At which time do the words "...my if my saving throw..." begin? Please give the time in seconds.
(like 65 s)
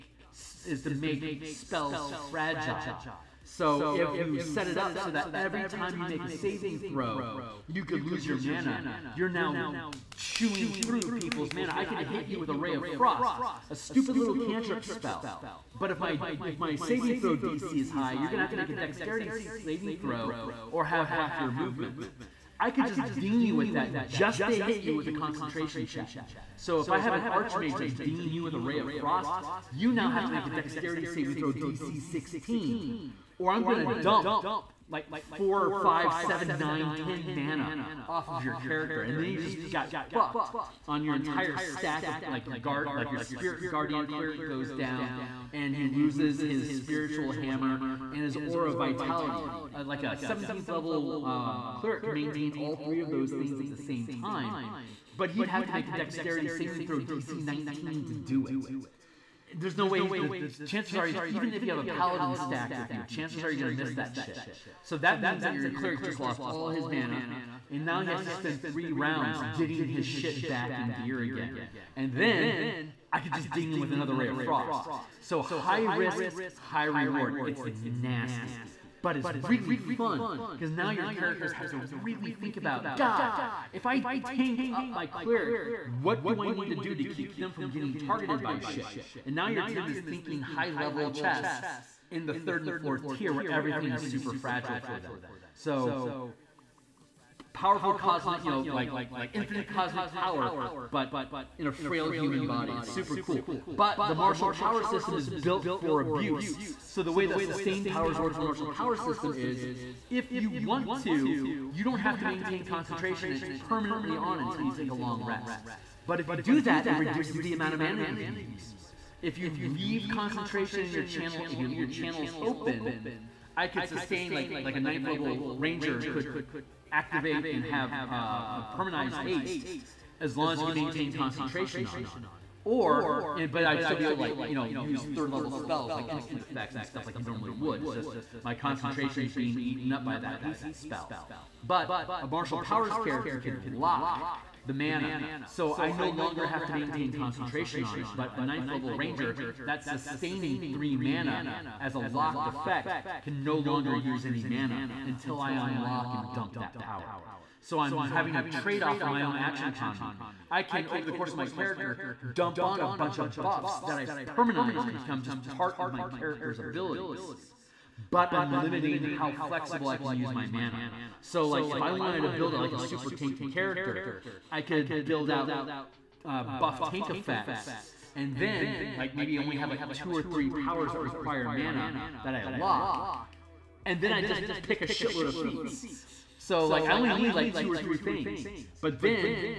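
15 s.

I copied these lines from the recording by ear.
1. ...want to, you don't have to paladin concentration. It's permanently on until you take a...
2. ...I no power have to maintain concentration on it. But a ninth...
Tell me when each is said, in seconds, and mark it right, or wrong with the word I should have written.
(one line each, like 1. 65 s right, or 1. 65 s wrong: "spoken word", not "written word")
1. 110 s wrong: "maintain", not "paladin"
2. 145 s wrong: "longer", not "power".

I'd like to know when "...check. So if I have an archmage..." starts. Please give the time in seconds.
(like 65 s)
25 s.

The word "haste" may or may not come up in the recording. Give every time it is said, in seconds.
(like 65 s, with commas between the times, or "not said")
129 s, 140 s.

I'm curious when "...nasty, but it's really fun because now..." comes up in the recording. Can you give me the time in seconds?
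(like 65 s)
78 s.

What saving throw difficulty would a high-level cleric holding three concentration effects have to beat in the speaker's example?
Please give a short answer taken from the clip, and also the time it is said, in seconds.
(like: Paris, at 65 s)
DC 19, at 56 s.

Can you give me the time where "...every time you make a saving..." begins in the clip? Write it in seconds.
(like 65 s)
5 s.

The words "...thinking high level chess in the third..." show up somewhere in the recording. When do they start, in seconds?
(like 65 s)
89 s.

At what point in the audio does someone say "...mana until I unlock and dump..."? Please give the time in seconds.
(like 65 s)
154 s.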